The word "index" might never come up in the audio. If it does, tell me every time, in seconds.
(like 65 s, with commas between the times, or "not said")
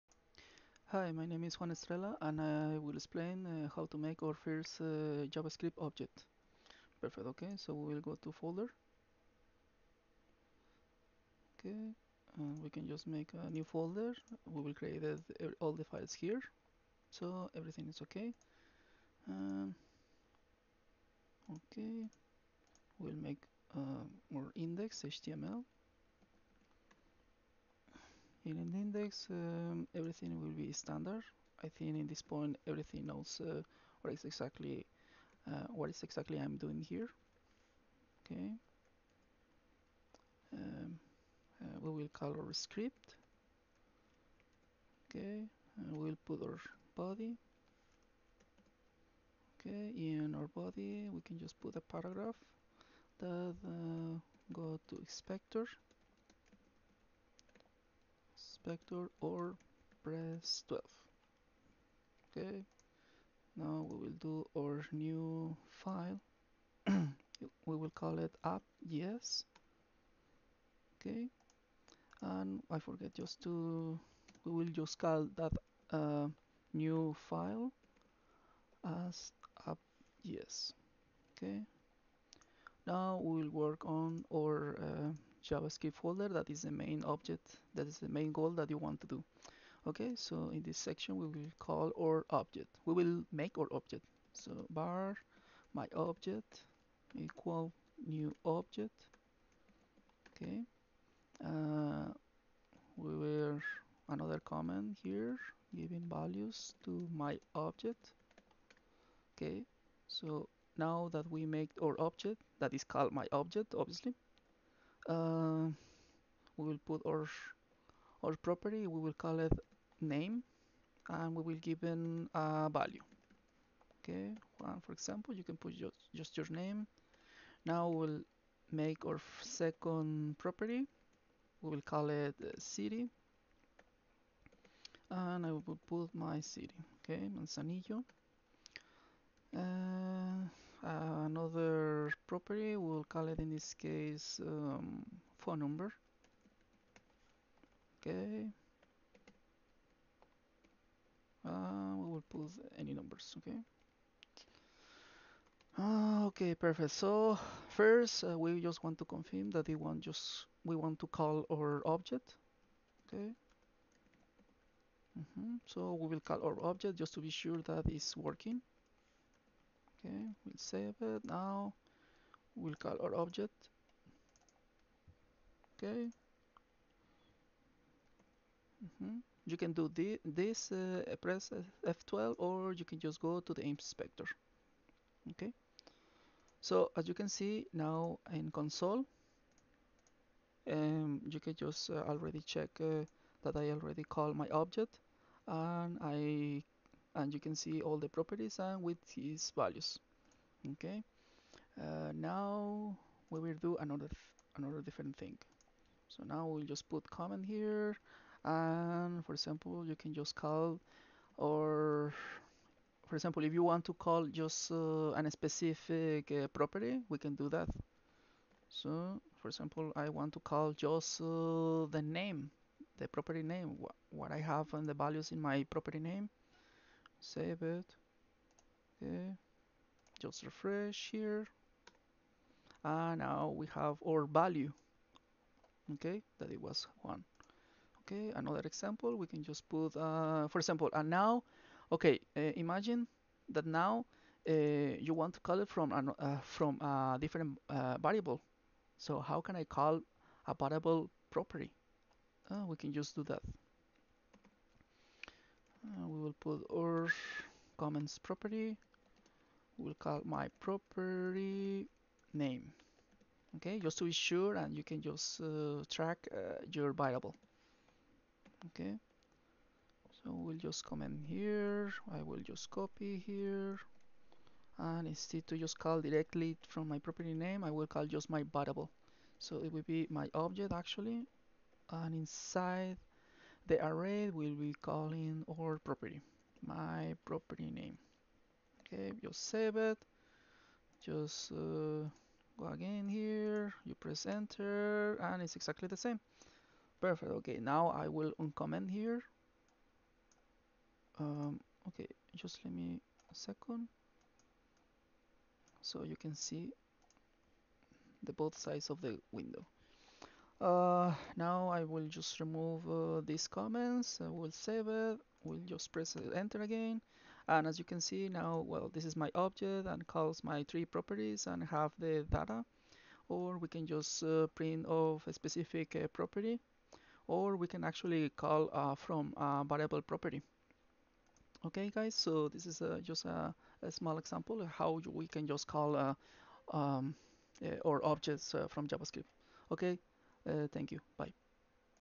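24 s, 28 s.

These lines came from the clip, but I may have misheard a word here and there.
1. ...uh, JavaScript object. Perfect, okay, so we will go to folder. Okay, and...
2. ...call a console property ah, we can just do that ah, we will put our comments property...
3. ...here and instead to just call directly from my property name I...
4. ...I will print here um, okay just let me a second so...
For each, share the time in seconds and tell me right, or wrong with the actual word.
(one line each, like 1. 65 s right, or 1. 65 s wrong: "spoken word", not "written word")
1. 4 s right
2. 249 s wrong: "variable", not "console"
3. 273 s right
4. 297 s wrong: "uncomment", not "print".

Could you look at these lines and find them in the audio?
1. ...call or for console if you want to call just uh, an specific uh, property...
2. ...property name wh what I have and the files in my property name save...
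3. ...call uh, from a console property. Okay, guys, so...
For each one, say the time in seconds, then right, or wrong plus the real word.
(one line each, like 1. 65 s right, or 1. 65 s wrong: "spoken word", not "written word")
1. 210 s wrong: "example", not "console"
2. 223 s wrong: "values", not "files"
3. 328 s wrong: "variable", not "console".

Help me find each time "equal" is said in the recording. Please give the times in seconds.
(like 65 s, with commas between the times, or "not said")
97 s.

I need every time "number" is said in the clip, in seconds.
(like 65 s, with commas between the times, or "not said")
145 s, 152 s.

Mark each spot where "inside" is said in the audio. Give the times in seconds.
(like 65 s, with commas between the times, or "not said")
282 s.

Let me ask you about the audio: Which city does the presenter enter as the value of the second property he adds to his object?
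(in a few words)
Manzanillo.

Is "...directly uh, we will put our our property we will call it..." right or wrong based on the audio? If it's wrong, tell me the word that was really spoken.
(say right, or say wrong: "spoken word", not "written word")
wrong: "obviously", not "directly".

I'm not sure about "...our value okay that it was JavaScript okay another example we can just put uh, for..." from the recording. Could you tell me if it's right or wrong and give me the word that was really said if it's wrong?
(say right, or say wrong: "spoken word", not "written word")
wrong: "Juan", not "JavaScript".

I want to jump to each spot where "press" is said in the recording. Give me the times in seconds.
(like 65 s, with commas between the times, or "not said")
60 s, 181 s, 293 s, 315 s.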